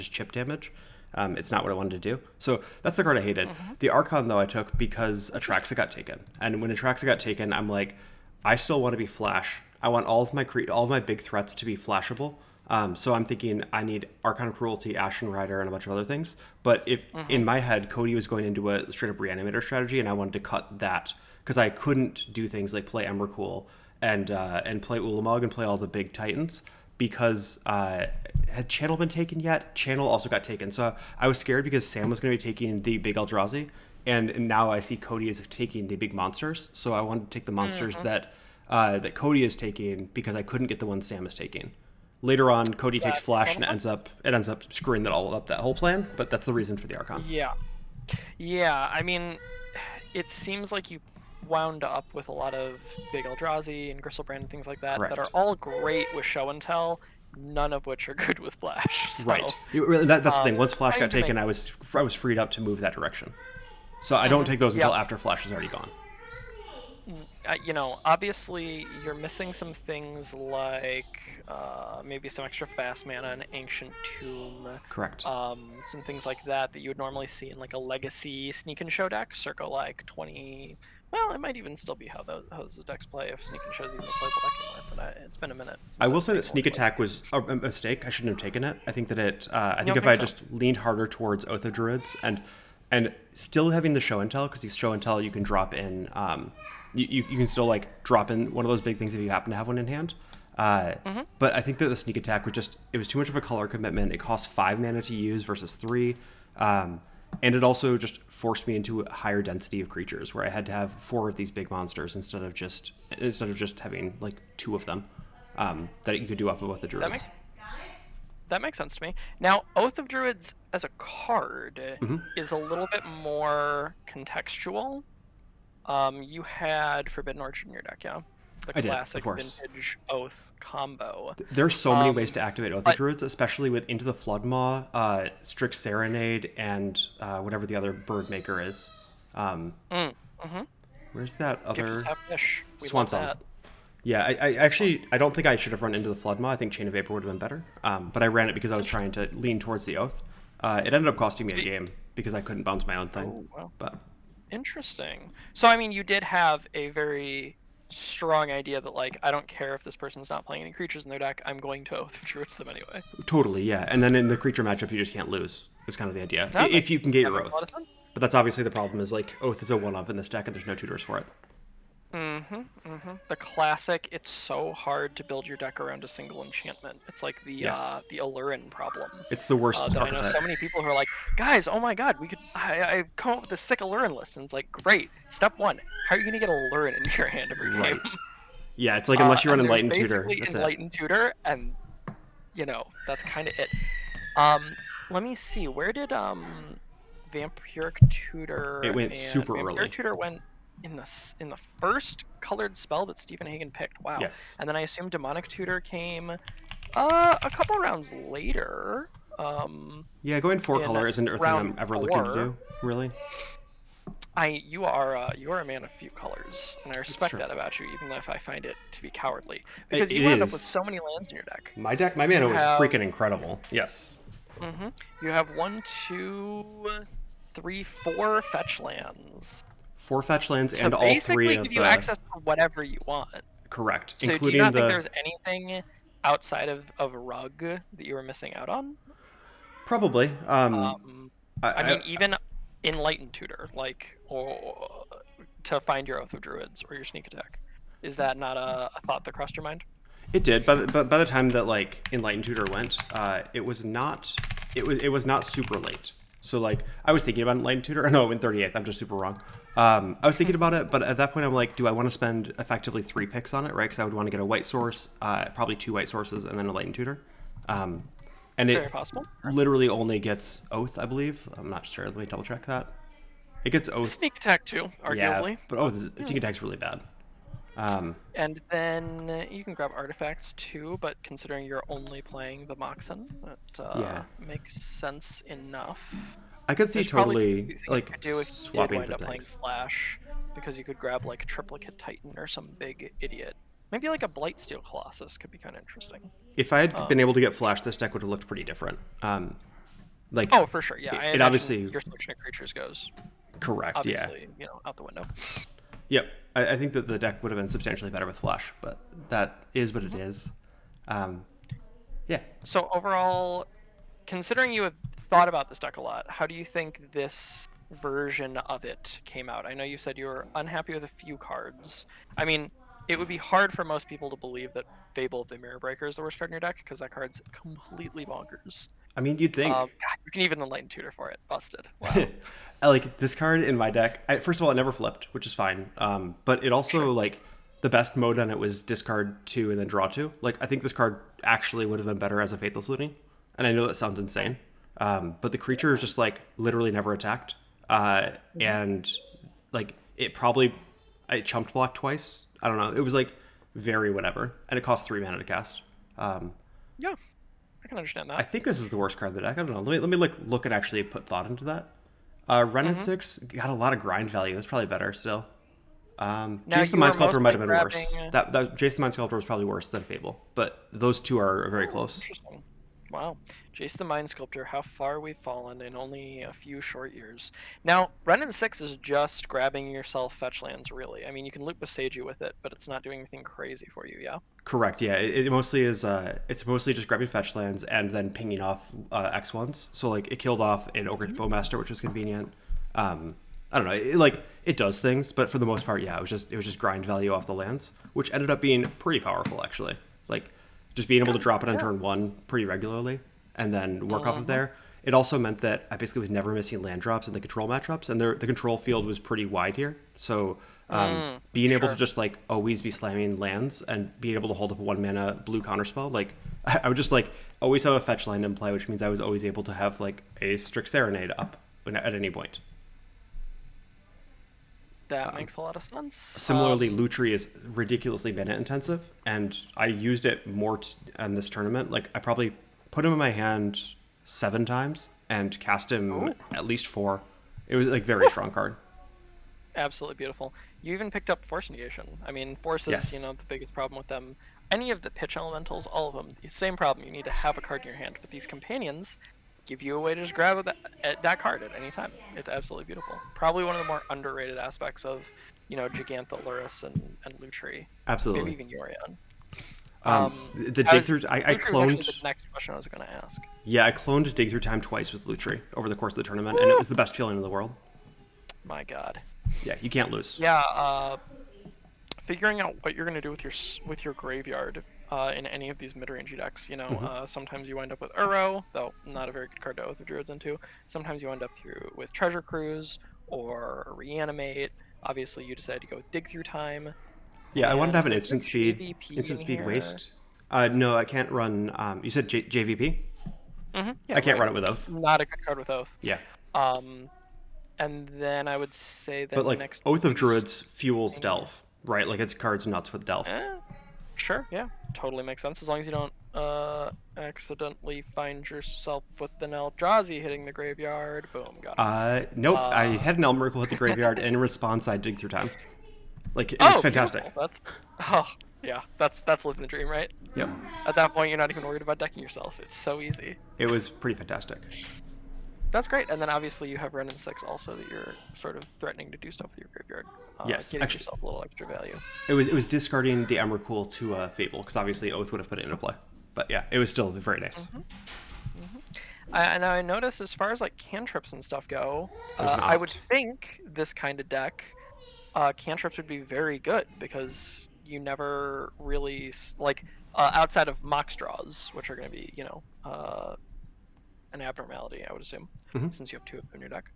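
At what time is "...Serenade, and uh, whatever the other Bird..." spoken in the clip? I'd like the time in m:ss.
2:15.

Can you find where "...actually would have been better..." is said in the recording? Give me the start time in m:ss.
5:41.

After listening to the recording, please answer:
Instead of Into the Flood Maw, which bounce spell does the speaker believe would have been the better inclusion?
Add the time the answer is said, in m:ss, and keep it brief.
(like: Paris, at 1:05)
Chain of Vapor, at 2:26.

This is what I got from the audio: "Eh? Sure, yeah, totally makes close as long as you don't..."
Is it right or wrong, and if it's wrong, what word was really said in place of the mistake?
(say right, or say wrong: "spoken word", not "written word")
wrong: "sense", not "close".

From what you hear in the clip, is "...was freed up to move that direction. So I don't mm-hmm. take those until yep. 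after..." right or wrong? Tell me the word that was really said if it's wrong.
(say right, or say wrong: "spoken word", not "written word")
right.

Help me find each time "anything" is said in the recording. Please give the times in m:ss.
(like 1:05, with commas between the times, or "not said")
3:55, 6:23.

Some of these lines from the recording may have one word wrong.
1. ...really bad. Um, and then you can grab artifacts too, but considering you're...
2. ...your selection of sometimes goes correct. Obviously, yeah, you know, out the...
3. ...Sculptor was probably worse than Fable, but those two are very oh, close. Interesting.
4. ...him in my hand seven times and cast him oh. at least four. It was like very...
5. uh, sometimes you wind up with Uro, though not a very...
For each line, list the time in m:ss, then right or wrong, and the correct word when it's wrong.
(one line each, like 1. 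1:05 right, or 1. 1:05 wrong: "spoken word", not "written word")
1. 4:36 right
2. 5:01 wrong: "creatures", not "sometimes"
3. 6:09 right
4. 7:13 right
5. 7:57 right.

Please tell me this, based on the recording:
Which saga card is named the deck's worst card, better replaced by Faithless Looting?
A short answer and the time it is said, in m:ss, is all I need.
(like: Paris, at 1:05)
Fable of the Mirror Breaker, at 5:25.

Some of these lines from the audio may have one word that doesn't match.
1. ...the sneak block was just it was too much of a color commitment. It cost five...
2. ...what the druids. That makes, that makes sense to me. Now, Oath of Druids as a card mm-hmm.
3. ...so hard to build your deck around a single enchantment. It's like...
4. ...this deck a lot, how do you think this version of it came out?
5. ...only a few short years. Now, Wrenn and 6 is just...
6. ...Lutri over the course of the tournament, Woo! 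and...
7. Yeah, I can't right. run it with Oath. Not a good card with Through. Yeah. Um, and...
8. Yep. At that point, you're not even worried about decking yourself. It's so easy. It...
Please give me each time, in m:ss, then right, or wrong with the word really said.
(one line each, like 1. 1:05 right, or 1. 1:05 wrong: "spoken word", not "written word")
1. 1:41 wrong: "attack", not "block"
2. 1:56 right
3. 2:54 right
4. 5:15 right
5. 6:15 right
6. 7:45 right
7. 8:14 wrong: "Oath", not "Through"
8. 8:40 right.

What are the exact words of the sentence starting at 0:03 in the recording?
The Archon, though, I took because Atraxa got taken.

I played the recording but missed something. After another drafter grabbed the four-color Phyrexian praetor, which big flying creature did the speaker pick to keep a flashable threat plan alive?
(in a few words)
Archon of Cruelty.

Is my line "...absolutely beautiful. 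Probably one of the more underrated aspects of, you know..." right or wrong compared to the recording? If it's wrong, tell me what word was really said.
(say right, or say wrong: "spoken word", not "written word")
right.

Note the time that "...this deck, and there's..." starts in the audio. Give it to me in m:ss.
2:50.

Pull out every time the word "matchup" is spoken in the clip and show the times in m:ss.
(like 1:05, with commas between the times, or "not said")
2:44, 6:47.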